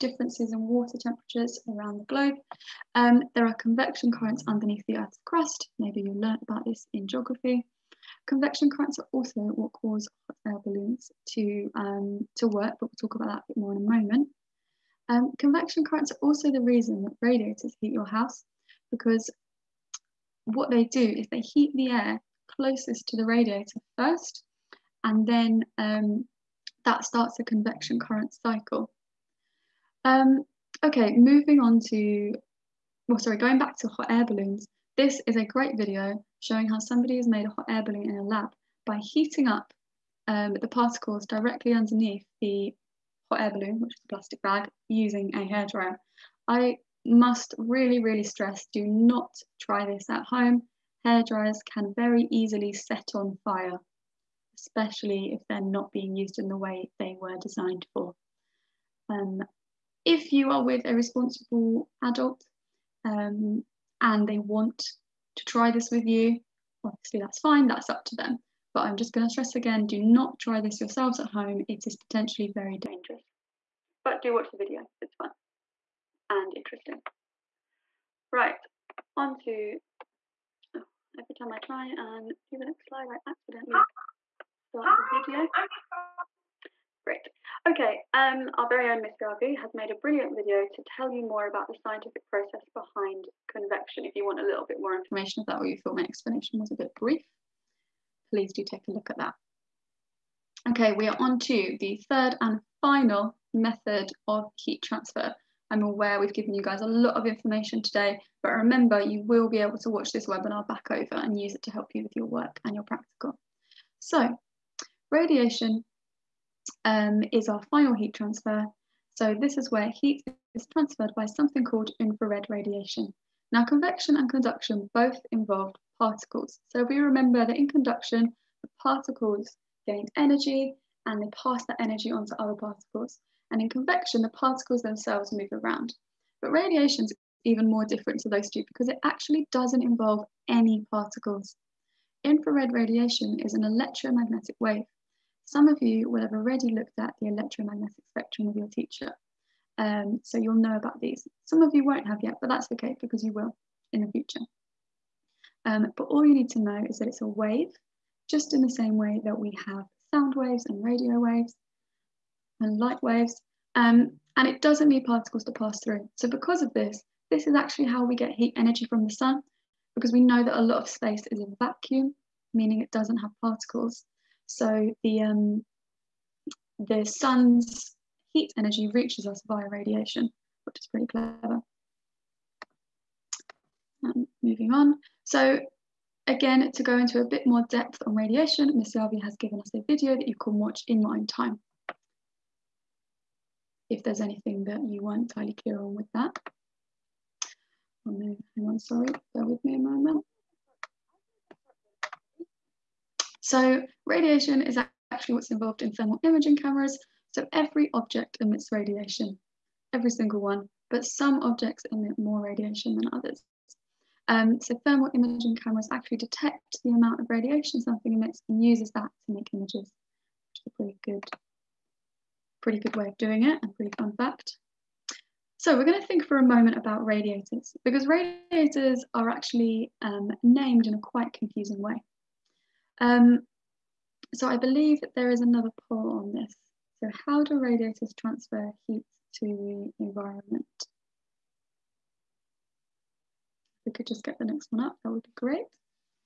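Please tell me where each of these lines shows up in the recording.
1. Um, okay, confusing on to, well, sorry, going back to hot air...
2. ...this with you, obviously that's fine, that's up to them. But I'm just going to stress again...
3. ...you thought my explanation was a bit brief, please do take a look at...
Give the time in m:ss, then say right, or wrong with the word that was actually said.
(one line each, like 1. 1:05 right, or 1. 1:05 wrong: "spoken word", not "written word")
1. 0:30 wrong: "moving", not "confusing"
2. 1:05 right
3. 1:35 right.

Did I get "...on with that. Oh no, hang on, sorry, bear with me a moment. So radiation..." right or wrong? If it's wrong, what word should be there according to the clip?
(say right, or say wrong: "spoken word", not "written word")
right.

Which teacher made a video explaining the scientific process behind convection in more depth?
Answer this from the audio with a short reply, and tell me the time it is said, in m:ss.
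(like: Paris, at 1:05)
Miss Garvey, at 1:28.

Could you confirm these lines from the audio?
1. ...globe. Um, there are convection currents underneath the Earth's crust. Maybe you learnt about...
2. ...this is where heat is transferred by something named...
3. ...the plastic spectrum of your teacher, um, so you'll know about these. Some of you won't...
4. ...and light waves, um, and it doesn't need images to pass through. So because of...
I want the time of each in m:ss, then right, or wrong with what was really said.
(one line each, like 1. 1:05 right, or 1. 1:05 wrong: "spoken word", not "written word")
1. 0:02 right
2. 1:59 wrong: "called", not "named"
3. 2:27 wrong: "electromagnetic", not "plastic"
4. 2:42 wrong: "particles", not "images".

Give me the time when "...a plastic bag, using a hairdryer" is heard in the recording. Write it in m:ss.
0:44.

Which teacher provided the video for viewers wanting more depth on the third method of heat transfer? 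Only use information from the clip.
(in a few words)
Miss Selvey.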